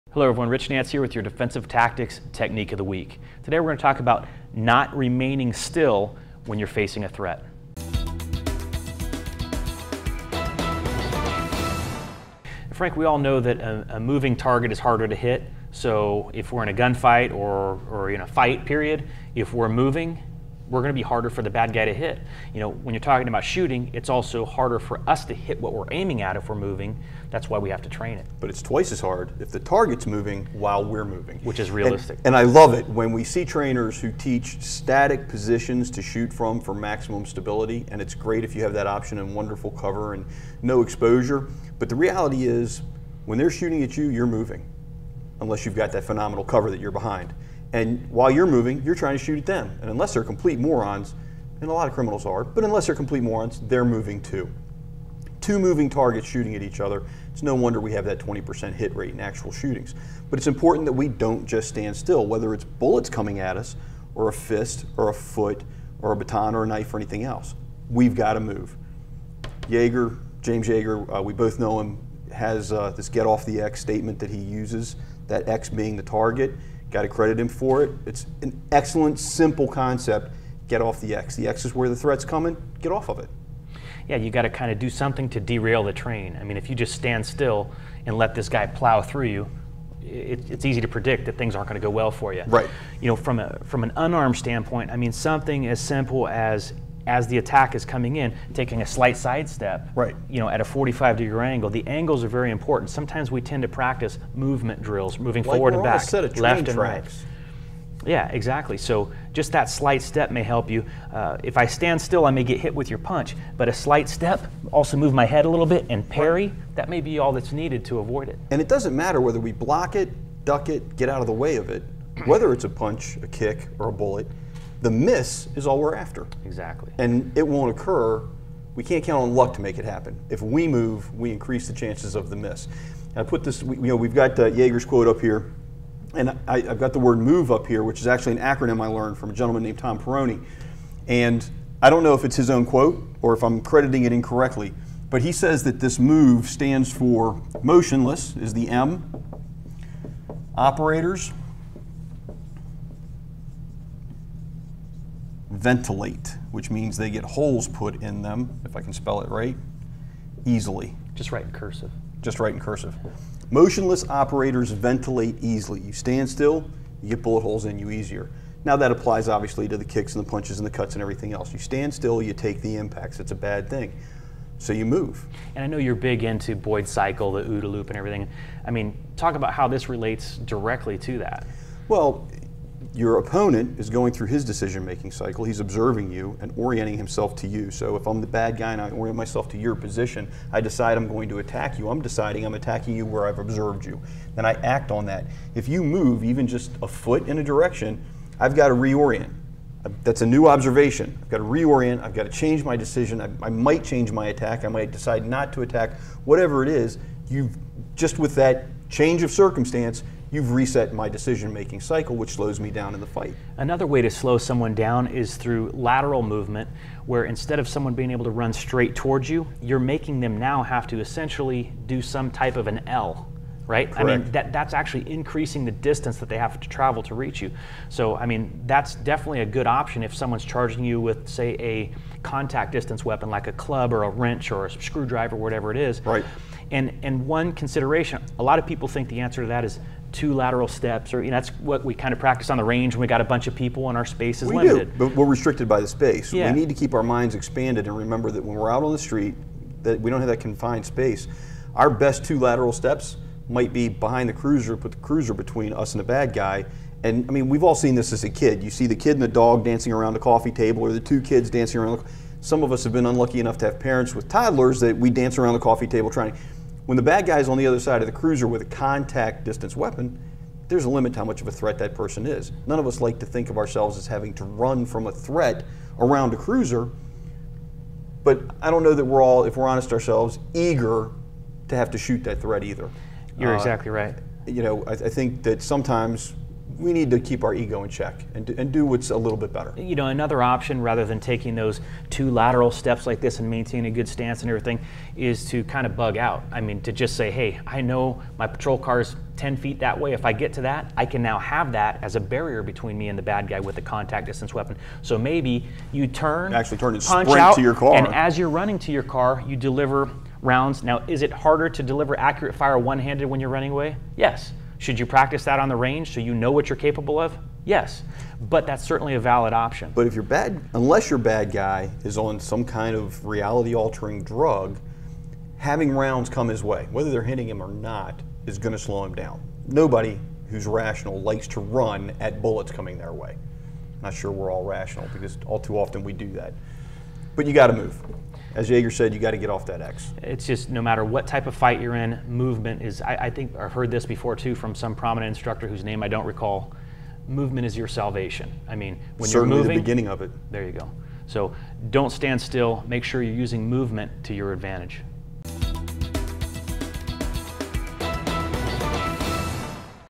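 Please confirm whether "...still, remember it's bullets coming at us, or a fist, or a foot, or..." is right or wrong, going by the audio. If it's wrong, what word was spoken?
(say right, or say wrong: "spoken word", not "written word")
wrong: "whether", not "remember".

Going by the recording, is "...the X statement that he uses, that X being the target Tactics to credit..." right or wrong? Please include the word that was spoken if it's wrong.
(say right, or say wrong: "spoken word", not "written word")
wrong: "Got", not "Tactics".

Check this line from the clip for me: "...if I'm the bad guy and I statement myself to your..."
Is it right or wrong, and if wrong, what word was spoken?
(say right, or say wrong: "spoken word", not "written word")
wrong: "orient", not "statement".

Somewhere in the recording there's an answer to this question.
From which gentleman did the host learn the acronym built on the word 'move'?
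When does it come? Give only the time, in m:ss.
2:19.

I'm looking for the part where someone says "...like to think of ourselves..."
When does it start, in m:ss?
4:32.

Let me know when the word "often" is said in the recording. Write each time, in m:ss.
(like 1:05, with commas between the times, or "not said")
5:35.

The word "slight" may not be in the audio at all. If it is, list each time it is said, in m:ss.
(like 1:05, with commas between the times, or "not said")
1:38, 1:49, 1:53.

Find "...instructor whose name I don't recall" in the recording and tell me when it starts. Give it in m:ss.
5:45.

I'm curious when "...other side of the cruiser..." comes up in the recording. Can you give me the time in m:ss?
4:27.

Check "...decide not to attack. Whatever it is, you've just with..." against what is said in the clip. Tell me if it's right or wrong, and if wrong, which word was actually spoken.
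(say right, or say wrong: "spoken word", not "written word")
right.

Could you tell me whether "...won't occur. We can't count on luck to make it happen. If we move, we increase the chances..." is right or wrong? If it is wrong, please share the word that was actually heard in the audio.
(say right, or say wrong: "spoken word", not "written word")
right.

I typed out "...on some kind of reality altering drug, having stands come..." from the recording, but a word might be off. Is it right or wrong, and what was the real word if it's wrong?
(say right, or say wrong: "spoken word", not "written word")
wrong: "rounds", not "stands".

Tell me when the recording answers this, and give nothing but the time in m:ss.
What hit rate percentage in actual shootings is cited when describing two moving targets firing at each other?
0:58.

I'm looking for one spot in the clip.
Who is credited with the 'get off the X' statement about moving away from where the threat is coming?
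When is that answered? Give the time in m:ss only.
1:10.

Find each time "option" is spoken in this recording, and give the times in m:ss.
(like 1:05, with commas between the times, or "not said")
0:38, 3:49, 4:50, 5:19.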